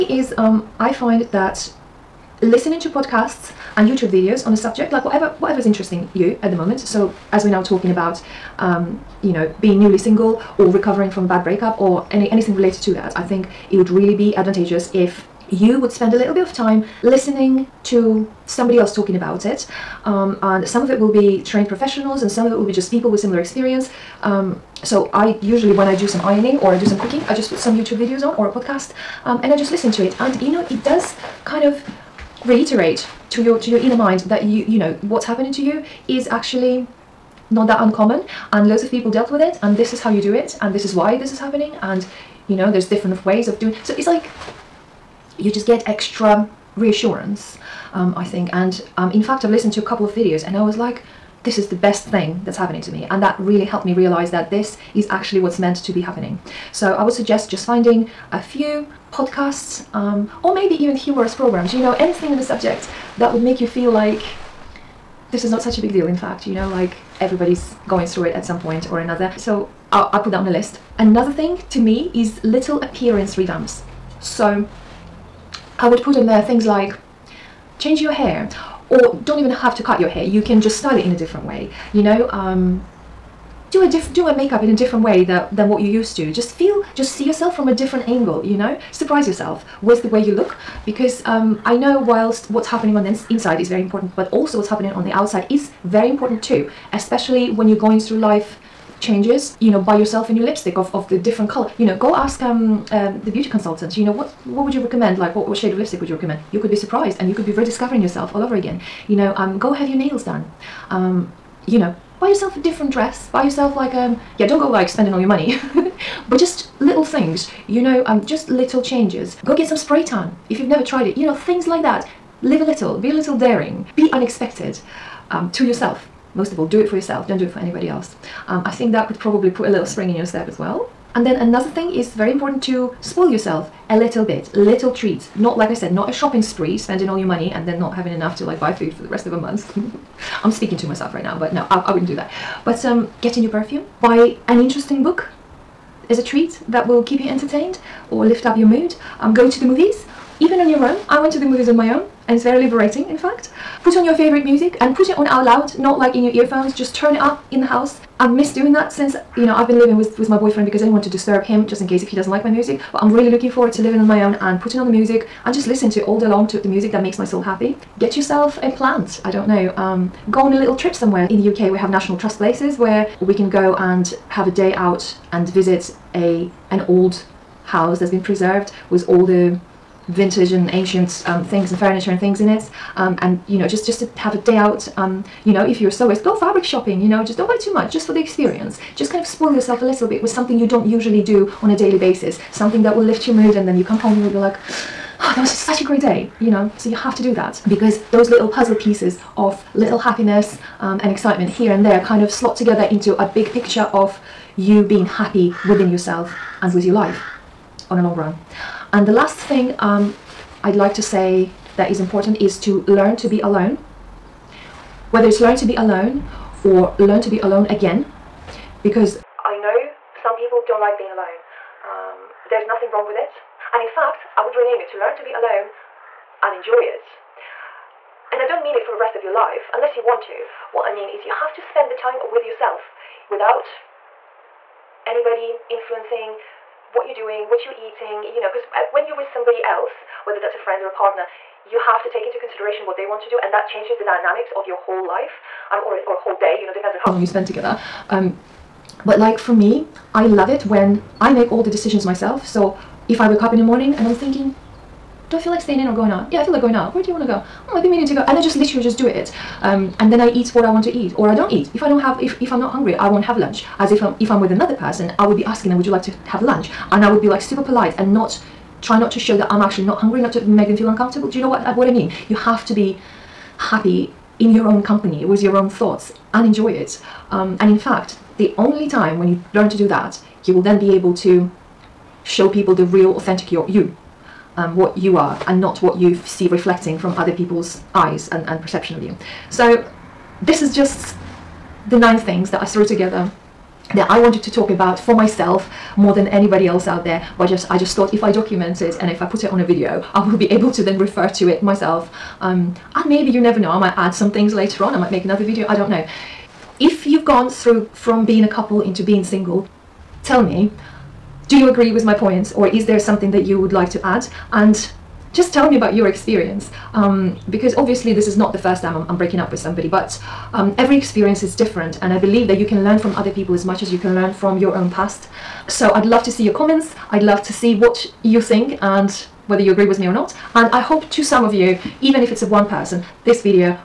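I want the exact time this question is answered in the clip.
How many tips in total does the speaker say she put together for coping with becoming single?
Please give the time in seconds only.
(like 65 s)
291 s.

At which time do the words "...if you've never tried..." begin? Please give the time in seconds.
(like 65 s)
120 s.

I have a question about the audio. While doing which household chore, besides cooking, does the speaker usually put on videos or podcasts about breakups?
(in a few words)
ironing.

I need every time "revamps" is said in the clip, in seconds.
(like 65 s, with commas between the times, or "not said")
73 s.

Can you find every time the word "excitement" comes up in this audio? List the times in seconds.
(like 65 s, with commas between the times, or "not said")
201 s.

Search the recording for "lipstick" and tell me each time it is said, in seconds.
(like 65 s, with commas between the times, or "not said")
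100 s, 105 s.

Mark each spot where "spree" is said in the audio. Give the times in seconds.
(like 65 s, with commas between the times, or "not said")
136 s.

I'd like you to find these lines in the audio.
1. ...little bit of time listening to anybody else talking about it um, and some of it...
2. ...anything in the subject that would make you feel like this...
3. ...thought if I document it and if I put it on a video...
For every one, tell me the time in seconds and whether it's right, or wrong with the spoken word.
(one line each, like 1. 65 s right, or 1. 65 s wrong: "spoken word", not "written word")
1. 16 s wrong: "somebody", not "anybody"
2. 62 s right
3. 297 s right.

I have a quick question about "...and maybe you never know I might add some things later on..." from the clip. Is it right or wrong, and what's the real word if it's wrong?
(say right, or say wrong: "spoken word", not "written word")
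right.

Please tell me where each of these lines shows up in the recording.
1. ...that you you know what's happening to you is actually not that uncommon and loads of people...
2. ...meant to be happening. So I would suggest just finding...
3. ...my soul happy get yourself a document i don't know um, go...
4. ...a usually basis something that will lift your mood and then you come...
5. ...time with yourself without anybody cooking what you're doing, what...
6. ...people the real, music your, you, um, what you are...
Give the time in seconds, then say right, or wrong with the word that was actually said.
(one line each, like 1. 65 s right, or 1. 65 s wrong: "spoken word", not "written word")
1. 34 s right
2. 55 s right
3. 167 s wrong: "plant", not "document"
4. 191 s wrong: "daily", not "usually"
5. 231 s wrong: "influencing", not "cooking"
6. 282 s wrong: "authentic", not "music".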